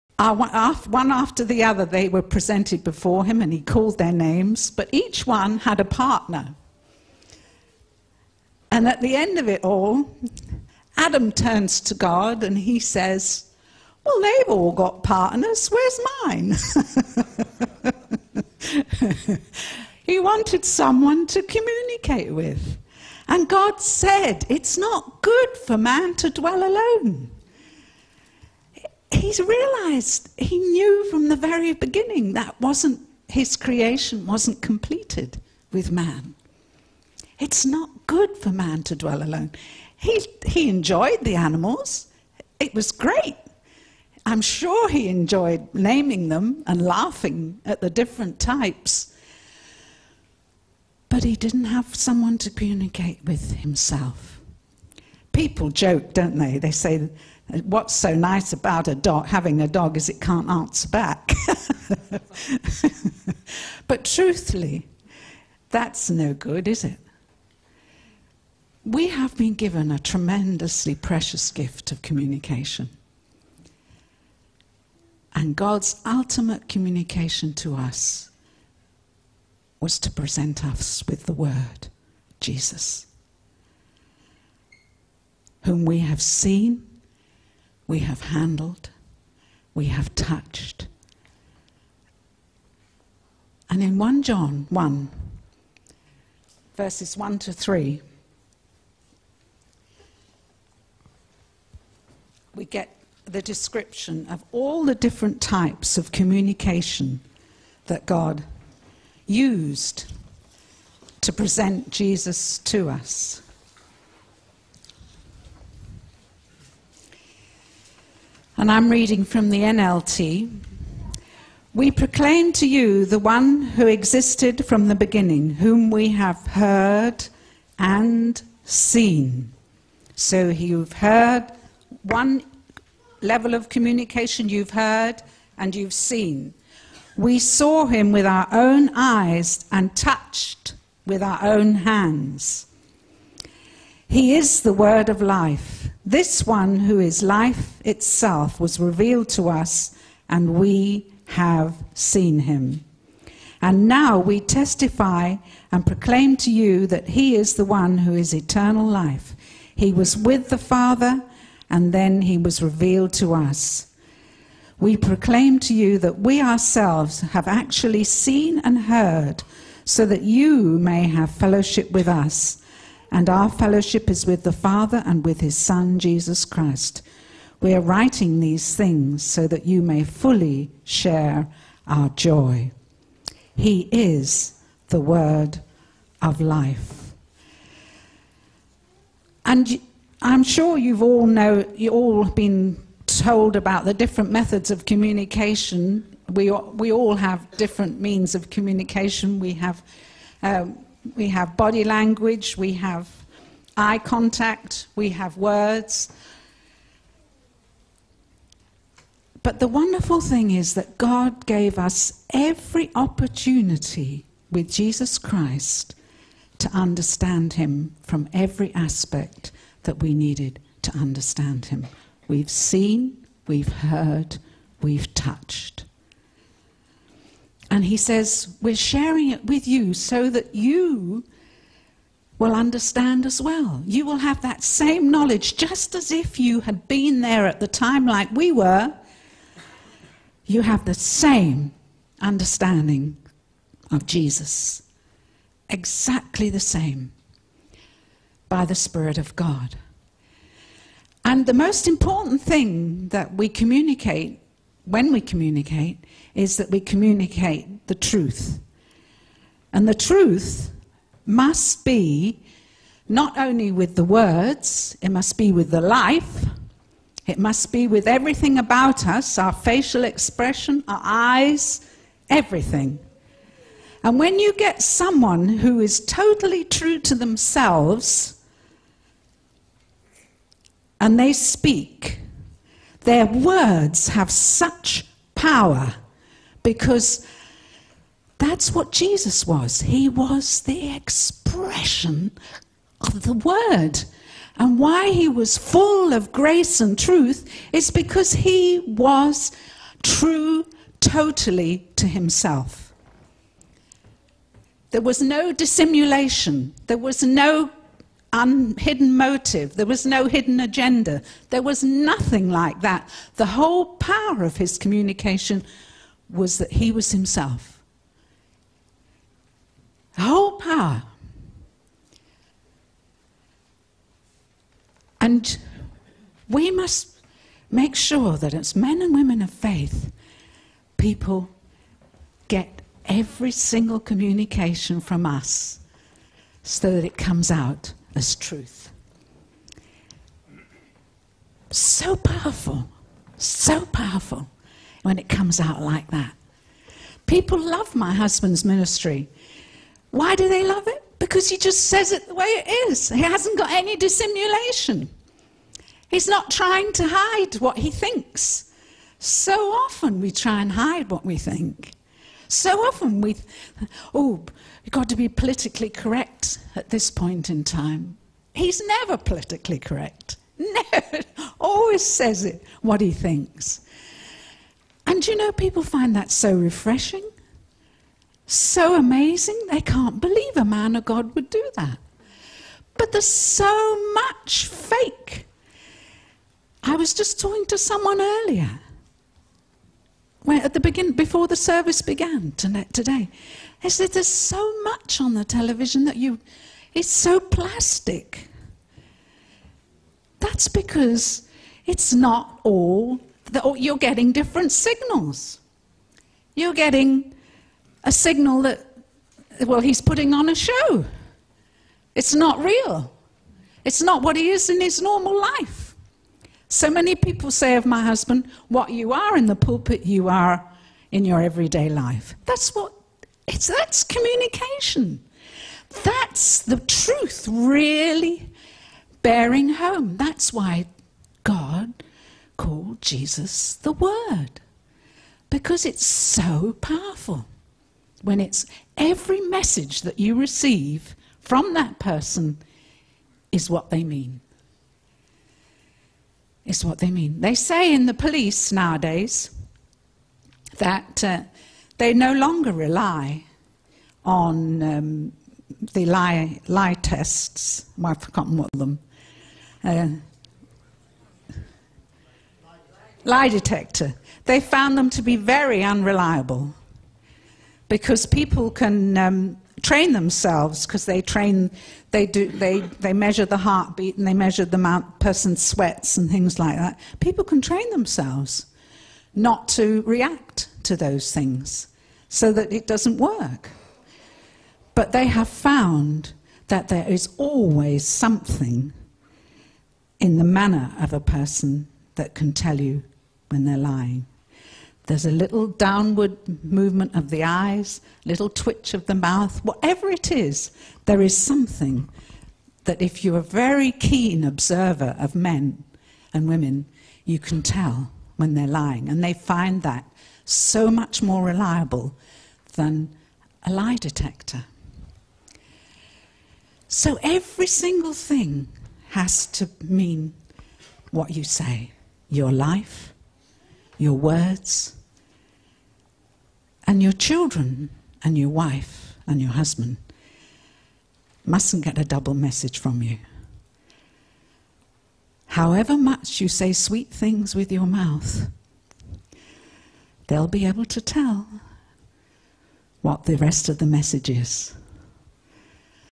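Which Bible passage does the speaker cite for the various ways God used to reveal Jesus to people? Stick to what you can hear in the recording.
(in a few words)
1 John 1, verses 1 to 3.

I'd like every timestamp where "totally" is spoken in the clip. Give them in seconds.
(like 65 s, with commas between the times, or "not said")
276 s, 300 s.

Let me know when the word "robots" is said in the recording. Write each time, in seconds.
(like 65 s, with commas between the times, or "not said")
not said.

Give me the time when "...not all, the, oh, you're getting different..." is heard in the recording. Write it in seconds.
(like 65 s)
402 s.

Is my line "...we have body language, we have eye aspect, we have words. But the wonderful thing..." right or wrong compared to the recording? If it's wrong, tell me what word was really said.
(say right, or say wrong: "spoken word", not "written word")
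wrong: "contact", not "aspect".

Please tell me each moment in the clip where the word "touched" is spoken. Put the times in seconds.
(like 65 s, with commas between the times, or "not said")
90 s, 139 s, 225 s.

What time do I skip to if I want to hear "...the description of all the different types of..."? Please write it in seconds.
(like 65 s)
103 s.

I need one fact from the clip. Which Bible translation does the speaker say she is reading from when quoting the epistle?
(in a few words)
NLT.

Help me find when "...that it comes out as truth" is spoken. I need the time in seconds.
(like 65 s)
336 s.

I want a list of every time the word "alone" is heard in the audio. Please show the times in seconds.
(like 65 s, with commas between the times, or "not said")
26 s, 39 s.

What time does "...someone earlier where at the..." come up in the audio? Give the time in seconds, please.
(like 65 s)
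387 s.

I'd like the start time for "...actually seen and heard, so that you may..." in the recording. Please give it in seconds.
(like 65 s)
167 s.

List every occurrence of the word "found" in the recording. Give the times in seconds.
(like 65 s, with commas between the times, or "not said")
464 s, 485 s.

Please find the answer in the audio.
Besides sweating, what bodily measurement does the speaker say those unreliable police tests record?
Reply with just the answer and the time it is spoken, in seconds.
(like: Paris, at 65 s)
Heartbeat, at 473 s.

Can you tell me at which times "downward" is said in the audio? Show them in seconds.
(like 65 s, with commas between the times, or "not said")
495 s.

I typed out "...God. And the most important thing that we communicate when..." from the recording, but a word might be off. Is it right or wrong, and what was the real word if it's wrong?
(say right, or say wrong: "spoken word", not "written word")
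right.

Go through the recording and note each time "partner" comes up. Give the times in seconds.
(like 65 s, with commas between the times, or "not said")
5 s, 15 s.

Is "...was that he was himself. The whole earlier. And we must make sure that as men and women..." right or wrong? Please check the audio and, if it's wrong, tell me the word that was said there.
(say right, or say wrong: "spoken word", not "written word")
wrong: "power", not "earlier".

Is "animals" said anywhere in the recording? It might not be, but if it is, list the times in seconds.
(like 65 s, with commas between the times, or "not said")
41 s.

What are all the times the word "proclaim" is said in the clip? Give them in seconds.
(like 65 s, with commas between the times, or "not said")
121 s, 155 s, 164 s.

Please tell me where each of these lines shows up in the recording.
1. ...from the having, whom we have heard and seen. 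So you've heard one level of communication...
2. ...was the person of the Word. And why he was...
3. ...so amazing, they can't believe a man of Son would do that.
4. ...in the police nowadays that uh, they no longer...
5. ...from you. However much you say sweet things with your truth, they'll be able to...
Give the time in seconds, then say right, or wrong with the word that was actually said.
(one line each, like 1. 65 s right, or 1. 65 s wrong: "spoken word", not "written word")
1. 124 s wrong: "beginning", not "having"
2. 290 s wrong: "expression", not "person"
3. 378 s wrong: "God", not "Son"
4. 447 s right
5. 532 s wrong: "mouth", not "truth".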